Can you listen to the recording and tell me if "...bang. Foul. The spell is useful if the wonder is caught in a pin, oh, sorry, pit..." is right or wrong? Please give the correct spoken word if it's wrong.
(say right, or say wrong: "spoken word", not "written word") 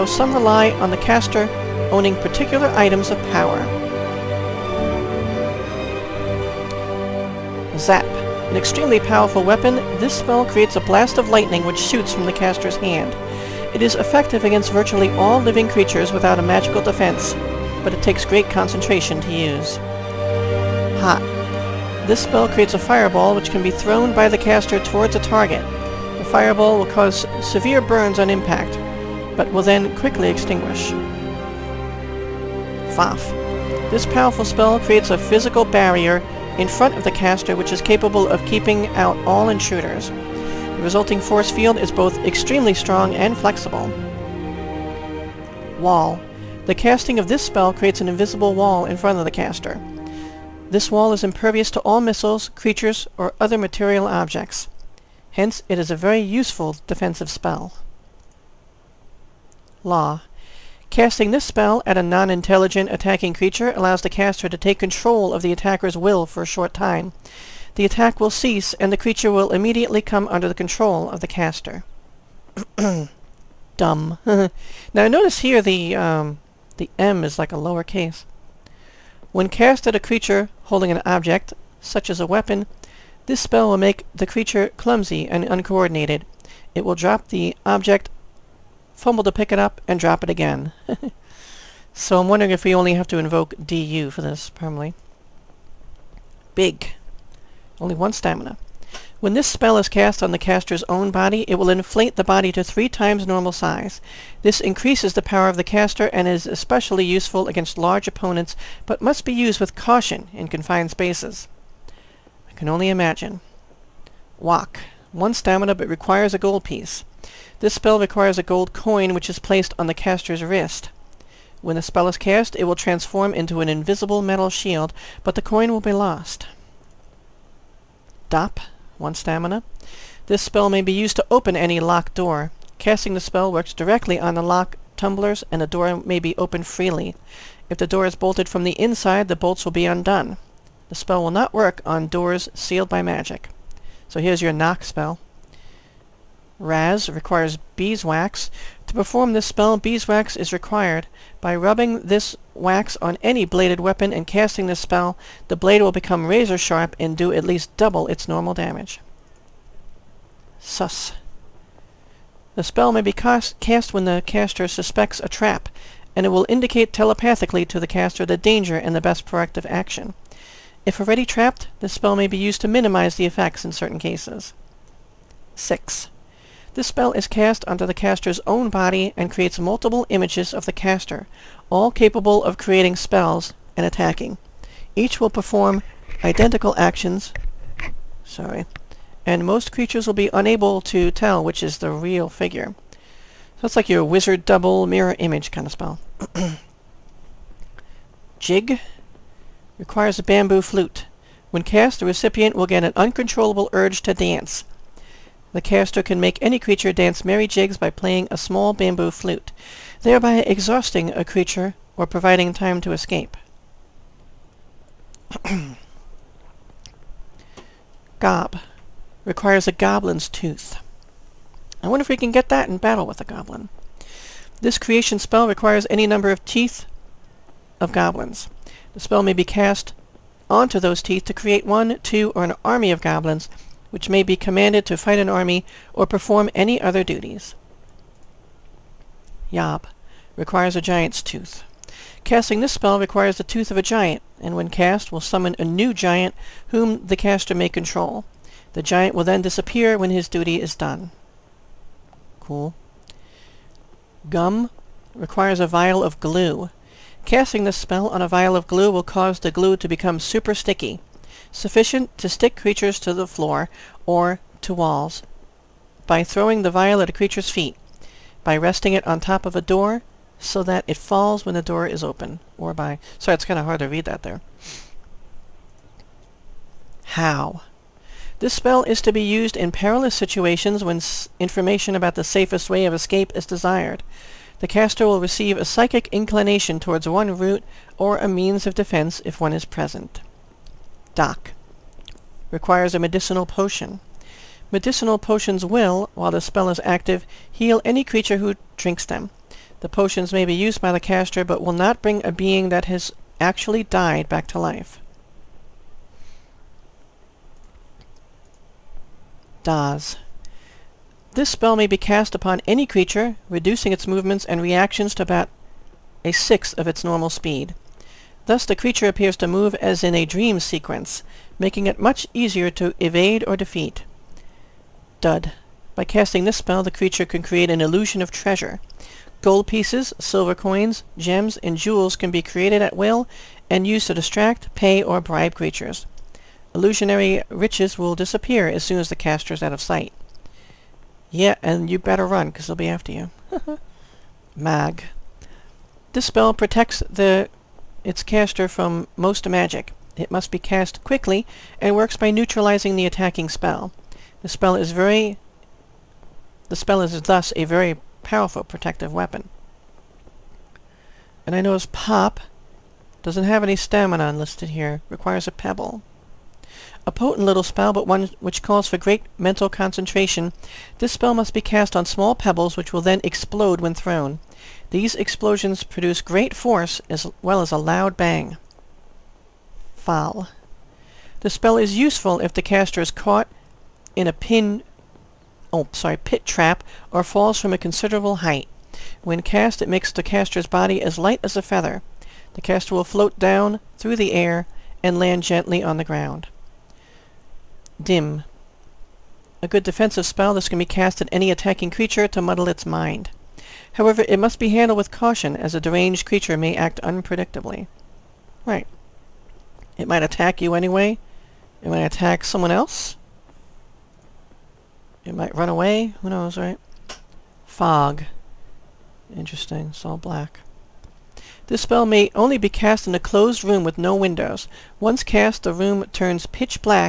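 wrong: "caster", not "wonder".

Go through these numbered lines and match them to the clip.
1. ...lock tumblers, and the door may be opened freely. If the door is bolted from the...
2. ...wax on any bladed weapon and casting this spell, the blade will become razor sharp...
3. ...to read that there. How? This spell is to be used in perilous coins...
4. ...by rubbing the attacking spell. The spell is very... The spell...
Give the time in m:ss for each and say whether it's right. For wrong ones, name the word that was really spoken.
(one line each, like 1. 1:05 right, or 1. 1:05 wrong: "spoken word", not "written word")
1. 2:14 right
2. 2:32 right
3. 4:33 wrong: "situations", not "coins"
4. 5:52 wrong: "neutralizing", not "rubbing".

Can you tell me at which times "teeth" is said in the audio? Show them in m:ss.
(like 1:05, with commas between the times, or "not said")
3:46, 3:51.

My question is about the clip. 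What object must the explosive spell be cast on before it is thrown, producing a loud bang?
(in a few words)
pebbles.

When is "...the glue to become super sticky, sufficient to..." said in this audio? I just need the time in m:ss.
4:19.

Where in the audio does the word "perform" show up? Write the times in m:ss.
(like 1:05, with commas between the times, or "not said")
2:28, 3:05, 3:56.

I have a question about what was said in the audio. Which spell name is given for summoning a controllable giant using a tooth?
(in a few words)
Yob.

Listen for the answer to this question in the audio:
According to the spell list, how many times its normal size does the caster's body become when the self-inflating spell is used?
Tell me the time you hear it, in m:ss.
1:42.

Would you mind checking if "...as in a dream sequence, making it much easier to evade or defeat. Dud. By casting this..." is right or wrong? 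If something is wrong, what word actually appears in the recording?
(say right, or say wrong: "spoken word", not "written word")
right.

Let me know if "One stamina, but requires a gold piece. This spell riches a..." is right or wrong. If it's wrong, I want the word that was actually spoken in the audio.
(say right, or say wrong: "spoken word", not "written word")
wrong: "requires", not "riches".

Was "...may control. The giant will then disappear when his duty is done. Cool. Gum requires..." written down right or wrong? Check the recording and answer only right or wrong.
right.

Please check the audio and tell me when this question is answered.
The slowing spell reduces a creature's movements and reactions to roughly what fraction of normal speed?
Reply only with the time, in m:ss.
5:16.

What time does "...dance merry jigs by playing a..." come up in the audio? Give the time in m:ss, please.
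3:26.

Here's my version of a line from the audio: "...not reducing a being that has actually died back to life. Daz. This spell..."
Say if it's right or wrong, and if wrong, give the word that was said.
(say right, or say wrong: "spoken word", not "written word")
wrong: "bring", not "reducing".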